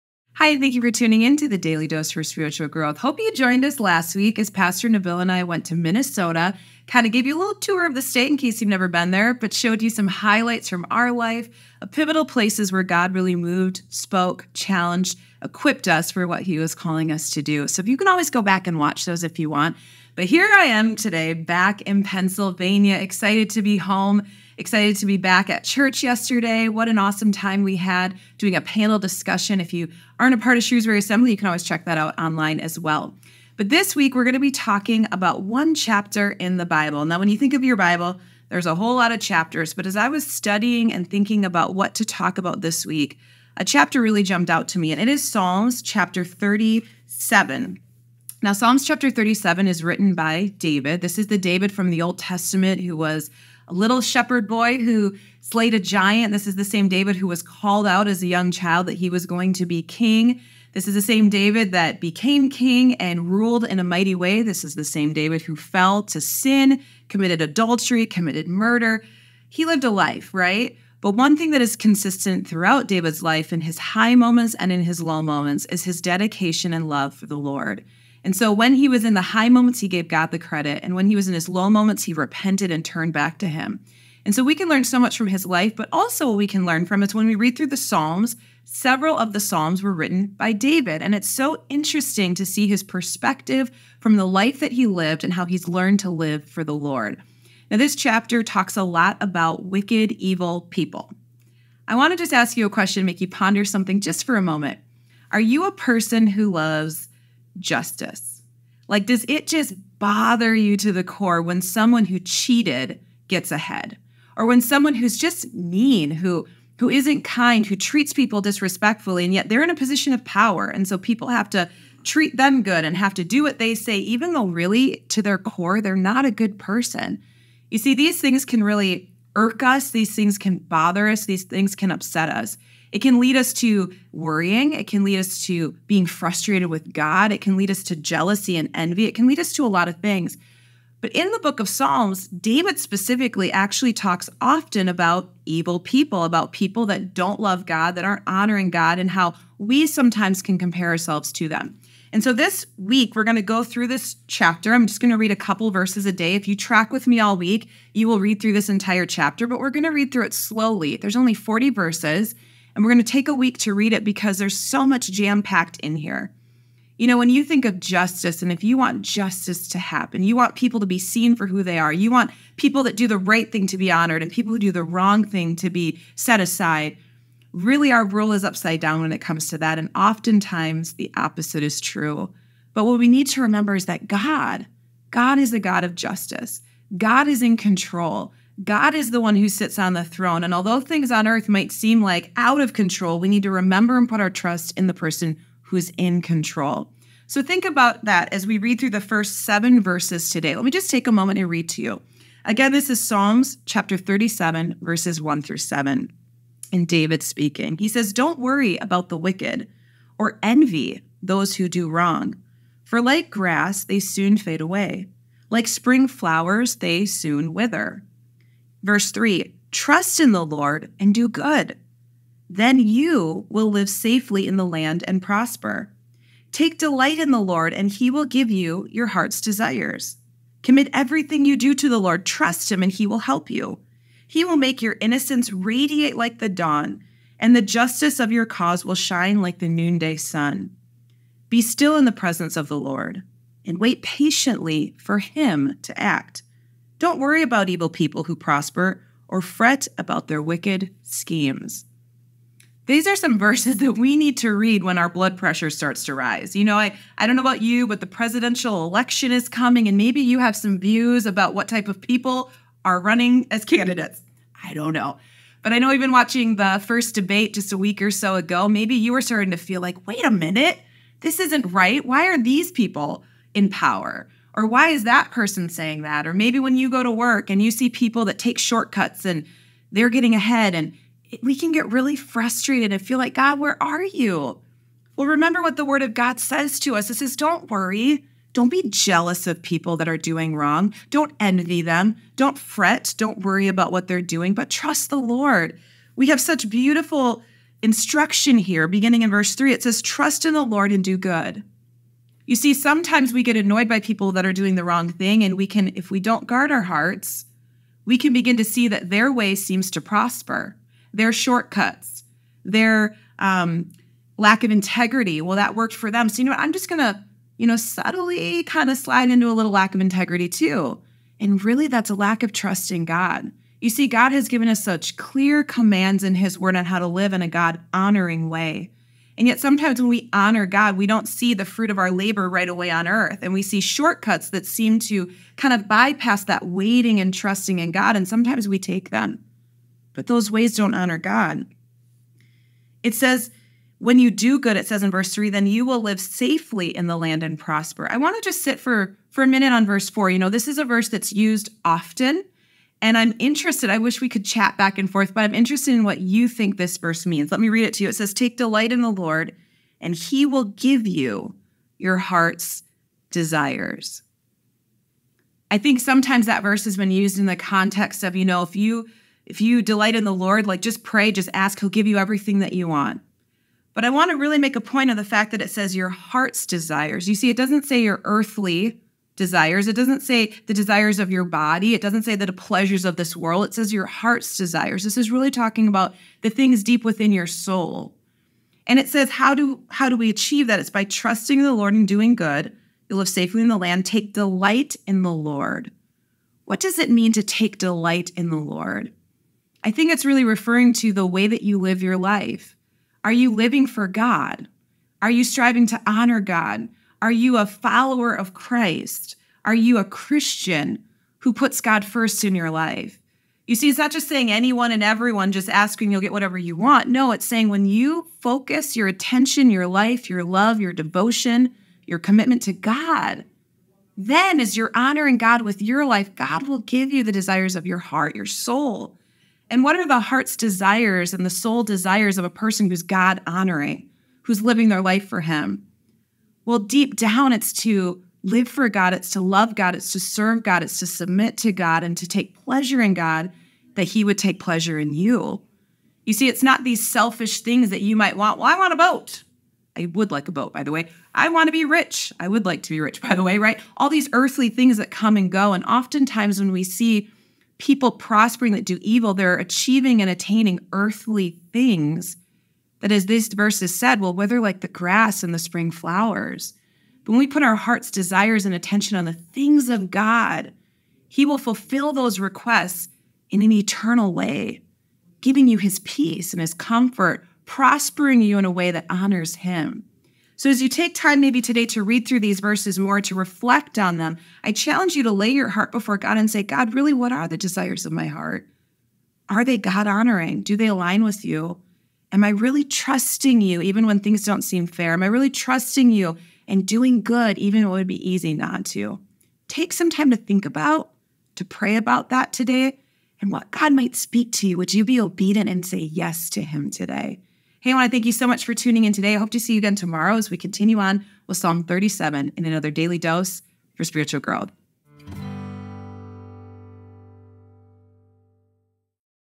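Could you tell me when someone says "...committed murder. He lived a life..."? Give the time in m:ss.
1:08.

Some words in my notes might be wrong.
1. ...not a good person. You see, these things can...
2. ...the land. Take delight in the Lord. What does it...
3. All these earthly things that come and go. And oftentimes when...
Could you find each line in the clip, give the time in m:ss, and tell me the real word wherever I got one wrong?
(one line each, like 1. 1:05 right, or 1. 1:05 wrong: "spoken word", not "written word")
1. 2:05 right
2. 6:33 right
3. 7:33 right.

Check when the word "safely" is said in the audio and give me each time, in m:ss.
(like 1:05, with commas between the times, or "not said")
3:43, 5:46, 6:33.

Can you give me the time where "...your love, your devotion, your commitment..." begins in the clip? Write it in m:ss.
7:00.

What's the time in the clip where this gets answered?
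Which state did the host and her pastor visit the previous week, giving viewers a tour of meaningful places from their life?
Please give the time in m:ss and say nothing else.
0:05.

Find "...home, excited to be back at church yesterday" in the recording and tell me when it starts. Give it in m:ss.
0:23.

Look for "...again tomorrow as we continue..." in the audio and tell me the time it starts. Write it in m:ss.
8:29.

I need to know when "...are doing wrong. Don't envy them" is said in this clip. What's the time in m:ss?
4:50.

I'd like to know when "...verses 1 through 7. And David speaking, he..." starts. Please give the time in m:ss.
3:24.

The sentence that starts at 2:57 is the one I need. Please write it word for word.
Really, our rule is upside down when it comes to that.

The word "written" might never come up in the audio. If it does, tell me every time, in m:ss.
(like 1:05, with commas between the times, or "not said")
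0:49, 1:29.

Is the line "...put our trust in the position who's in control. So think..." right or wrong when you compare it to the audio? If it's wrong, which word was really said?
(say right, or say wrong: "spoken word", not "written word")
wrong: "person", not "position".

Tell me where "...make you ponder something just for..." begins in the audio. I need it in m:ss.
1:43.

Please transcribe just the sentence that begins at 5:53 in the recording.
I wish we could chat back and forth, but I'm interested in what you think this verse means.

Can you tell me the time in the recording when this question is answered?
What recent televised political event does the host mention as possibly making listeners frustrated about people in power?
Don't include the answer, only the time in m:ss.
4:26.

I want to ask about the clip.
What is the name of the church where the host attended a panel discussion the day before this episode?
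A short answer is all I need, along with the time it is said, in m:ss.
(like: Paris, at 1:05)
Shrewsbury Assembly, at 0:30.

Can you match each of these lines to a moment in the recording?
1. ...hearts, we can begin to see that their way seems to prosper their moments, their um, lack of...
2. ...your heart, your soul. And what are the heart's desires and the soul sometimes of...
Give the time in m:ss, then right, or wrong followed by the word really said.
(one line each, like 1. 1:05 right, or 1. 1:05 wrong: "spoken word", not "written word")
1. 5:06 wrong: "shortcuts", not "moments"
2. 7:07 wrong: "desires", not "sometimes".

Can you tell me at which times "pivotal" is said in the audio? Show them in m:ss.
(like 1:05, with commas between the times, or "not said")
0:11.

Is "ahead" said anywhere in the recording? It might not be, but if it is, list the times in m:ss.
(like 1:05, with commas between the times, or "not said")
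1:53, 4:40.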